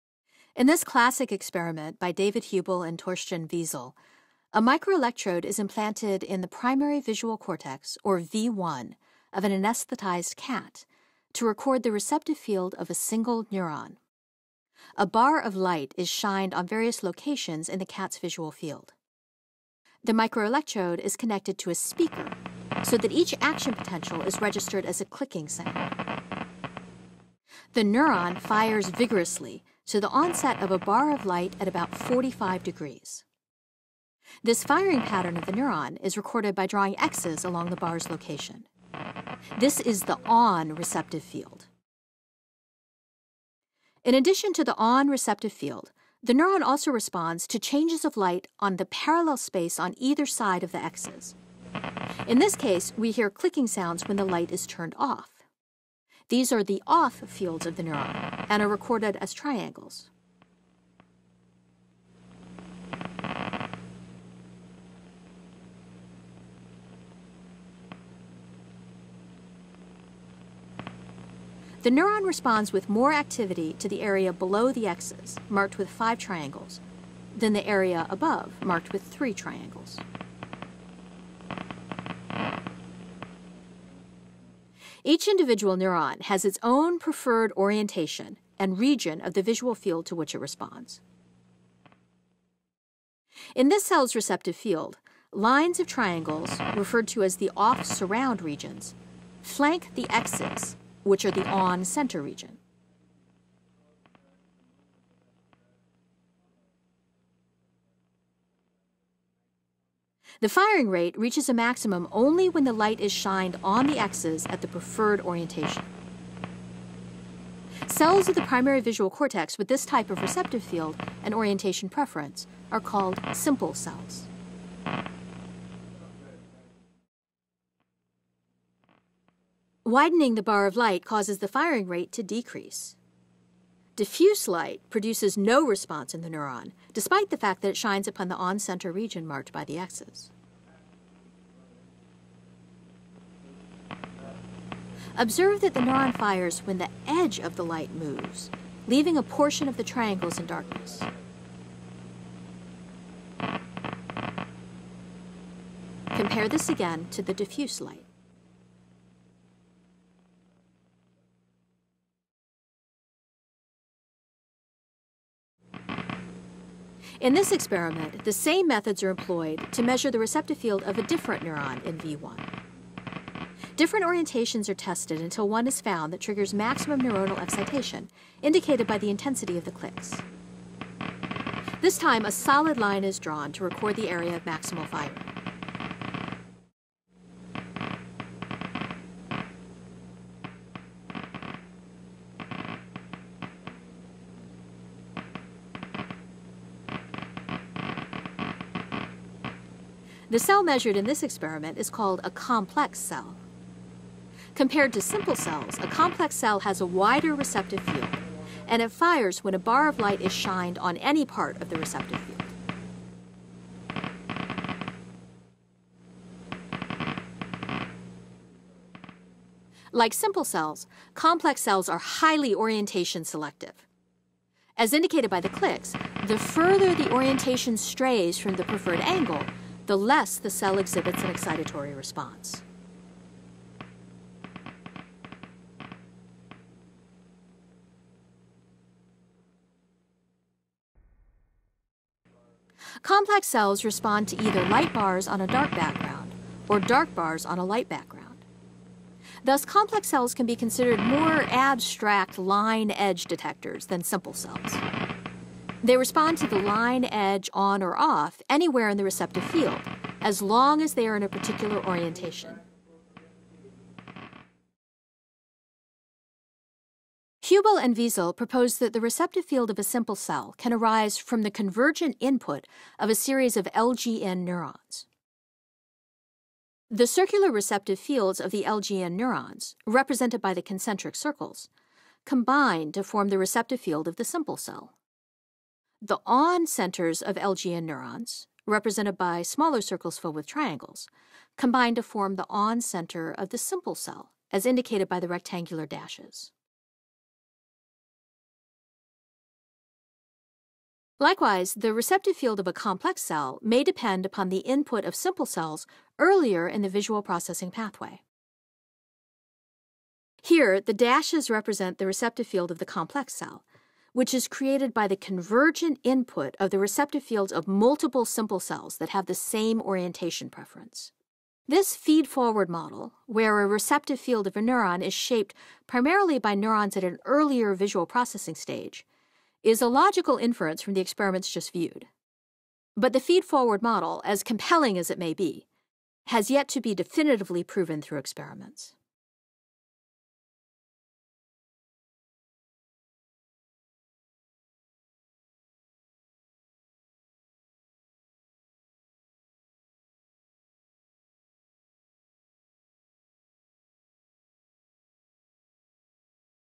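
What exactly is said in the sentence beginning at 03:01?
This time, a solid line is drawn to record the area of maximal firing.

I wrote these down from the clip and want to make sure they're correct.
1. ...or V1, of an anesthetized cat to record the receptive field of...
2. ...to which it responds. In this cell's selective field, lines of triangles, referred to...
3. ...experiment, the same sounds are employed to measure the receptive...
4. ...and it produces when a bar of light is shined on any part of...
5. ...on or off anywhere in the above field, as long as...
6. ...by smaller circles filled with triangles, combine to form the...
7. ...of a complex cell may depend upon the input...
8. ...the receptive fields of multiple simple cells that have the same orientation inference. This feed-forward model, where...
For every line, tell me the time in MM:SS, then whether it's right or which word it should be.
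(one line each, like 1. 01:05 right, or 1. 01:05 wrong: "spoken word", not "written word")
1. 00:08 right
2. 01:30 wrong: "receptive", not "selective"
3. 02:47 wrong: "methods", not "sounds"
4. 03:28 wrong: "fires", not "produces"
5. 04:17 wrong: "receptive", not "above"
6. 04:49 right
7. 05:02 right
8. 05:16 wrong: "preference", not "inference".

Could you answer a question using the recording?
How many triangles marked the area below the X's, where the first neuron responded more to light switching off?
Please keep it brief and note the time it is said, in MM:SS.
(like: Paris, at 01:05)
5, at 01:15.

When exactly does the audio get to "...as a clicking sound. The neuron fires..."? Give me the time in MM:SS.
00:24.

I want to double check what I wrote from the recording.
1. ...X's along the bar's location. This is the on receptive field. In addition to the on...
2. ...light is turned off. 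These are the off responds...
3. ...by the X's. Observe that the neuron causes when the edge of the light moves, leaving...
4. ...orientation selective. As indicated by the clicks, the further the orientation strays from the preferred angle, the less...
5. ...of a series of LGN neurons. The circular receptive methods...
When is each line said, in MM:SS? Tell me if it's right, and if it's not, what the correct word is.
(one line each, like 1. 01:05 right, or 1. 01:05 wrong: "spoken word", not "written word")
1. 00:36 right
2. 00:54 wrong: "fields", not "responds"
3. 02:19 wrong: "fires", not "causes"
4. 03:42 right
5. 04:32 wrong: "fields", not "methods".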